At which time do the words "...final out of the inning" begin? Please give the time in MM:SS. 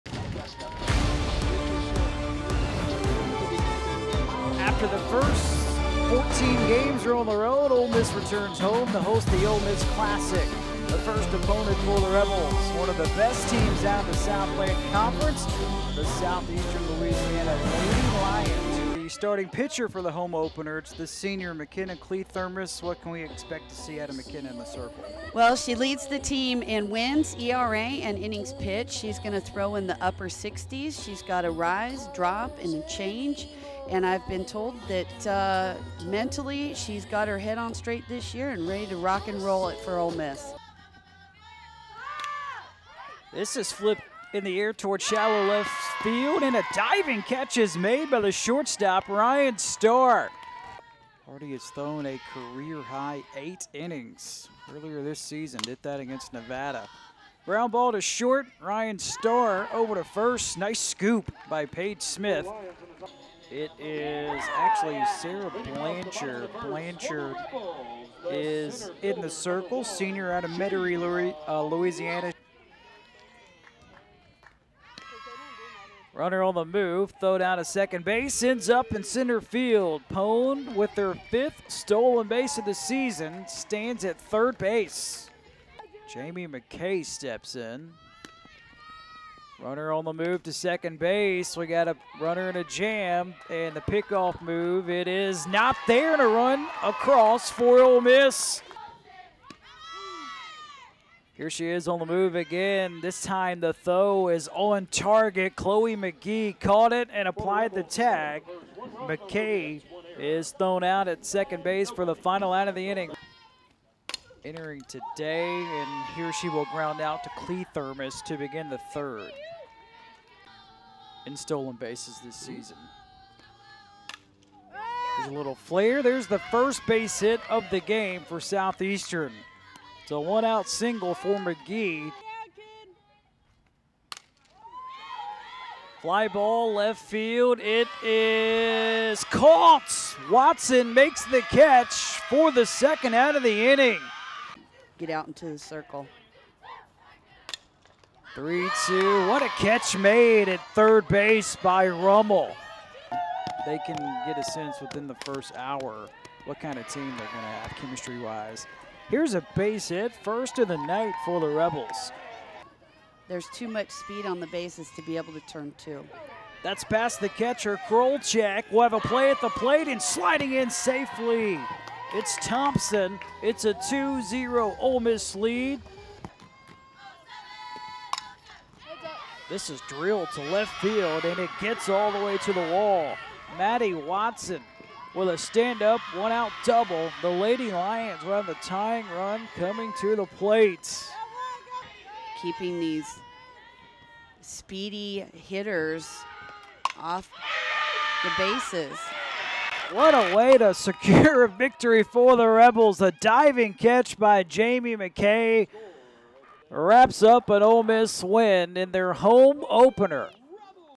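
01:52.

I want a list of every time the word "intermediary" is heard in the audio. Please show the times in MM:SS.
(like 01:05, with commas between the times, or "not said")
not said.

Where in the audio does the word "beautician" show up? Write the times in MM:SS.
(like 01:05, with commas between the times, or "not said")
not said.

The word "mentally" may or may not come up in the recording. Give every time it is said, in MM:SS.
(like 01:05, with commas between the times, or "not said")
00:36.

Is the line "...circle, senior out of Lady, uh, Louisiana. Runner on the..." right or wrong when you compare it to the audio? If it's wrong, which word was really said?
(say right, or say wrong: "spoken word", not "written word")
wrong: "Metairie", not "Lady".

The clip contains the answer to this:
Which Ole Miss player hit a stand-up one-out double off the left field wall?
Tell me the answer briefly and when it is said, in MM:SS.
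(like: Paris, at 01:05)
Maddie Watson, at 03:03.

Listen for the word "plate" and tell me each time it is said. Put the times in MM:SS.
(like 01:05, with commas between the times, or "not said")
02:49, 03:10.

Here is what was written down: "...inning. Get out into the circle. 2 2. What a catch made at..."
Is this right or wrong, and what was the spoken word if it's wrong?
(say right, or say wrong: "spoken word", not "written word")
wrong: "3", not "2".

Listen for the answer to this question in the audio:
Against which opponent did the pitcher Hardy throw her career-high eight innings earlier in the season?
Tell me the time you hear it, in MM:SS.
00:56.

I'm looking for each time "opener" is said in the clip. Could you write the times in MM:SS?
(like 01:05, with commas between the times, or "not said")
00:20, 03:29.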